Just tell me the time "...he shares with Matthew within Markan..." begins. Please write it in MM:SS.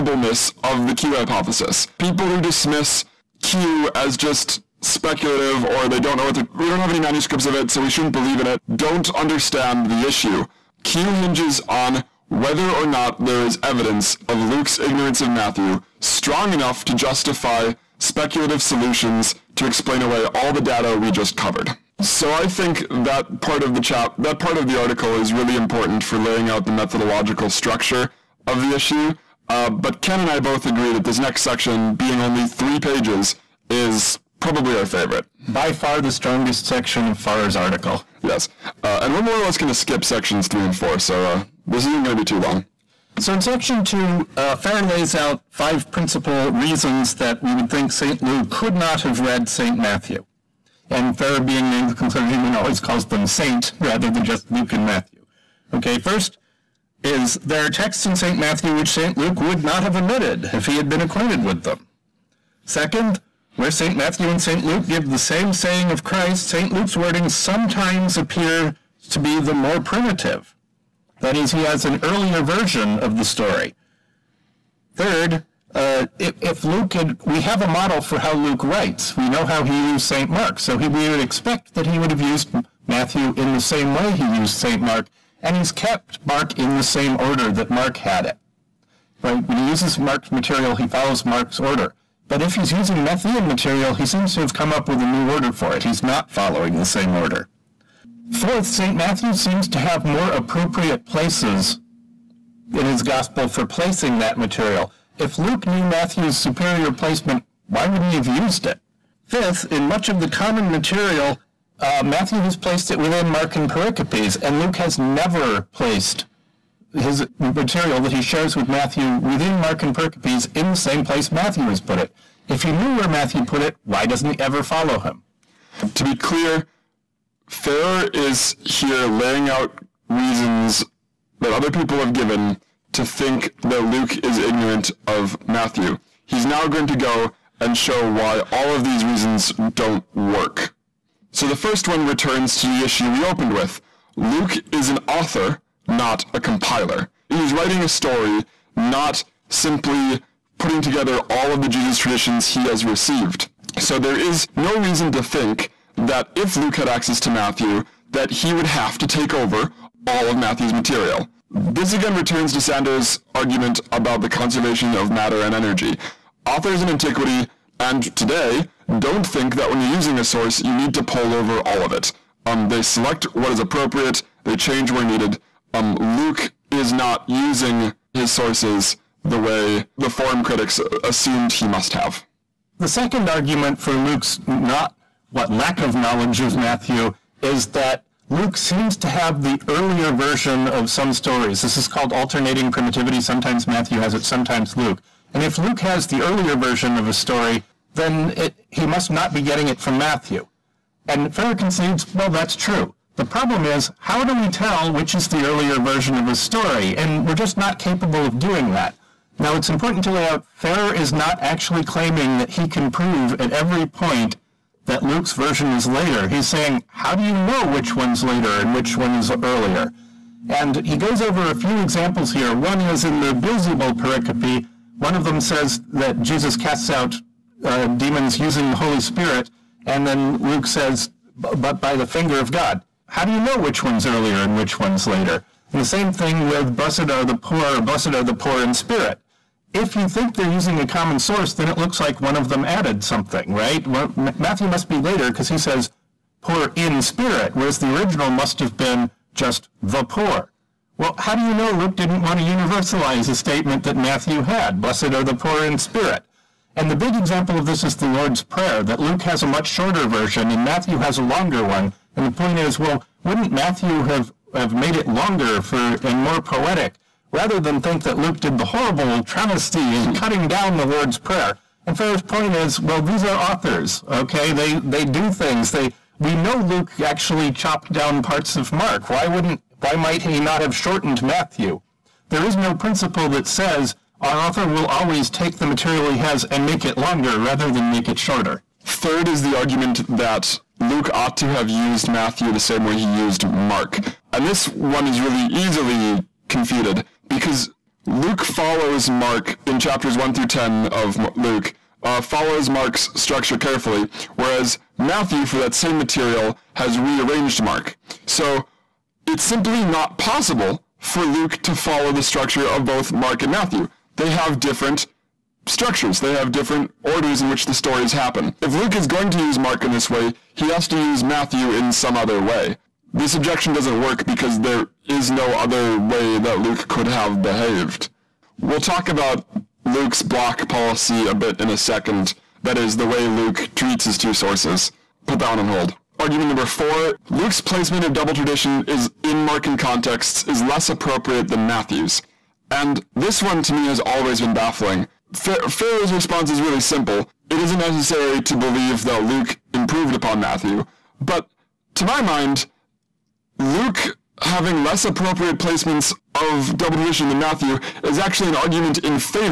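01:58.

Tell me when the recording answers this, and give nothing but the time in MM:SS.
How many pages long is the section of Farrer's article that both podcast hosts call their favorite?
00:32.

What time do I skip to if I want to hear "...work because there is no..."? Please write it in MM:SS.
05:23.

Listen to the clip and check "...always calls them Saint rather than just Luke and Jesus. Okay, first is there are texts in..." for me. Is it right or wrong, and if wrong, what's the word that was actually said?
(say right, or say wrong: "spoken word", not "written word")
wrong: "Matthew", not "Jesus".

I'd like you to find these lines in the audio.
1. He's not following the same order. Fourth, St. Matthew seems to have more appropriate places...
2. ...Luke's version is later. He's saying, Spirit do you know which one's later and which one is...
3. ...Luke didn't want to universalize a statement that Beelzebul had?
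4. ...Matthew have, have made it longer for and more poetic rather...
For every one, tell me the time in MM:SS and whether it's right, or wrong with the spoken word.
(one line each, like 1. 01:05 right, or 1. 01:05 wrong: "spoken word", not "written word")
1. 01:35 right
2. 03:35 wrong: "How", not "Spirit"
3. 04:11 wrong: "Matthew", not "Beelzebul"
4. 04:23 right.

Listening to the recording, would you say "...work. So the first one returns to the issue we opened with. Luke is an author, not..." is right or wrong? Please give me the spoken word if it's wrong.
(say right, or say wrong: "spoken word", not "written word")
right.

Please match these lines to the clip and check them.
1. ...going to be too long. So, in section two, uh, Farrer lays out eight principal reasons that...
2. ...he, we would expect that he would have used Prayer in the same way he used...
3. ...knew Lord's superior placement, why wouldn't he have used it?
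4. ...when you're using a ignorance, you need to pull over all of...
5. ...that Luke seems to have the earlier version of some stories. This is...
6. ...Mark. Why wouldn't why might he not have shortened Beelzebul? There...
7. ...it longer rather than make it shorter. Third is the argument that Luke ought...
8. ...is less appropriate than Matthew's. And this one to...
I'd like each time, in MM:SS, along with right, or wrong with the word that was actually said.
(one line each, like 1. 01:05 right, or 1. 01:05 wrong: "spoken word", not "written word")
1. 00:42 wrong: "five", not "eight"
2. 01:20 wrong: "Matthew", not "Prayer"
3. 01:45 wrong: "Matthew", not "Lord"
4. 02:49 wrong: "source", not "ignorance"
5. 03:07 right
6. 04:38 wrong: "Matthew", not "Beelzebul"
7. 04:46 right
8. 05:40 right.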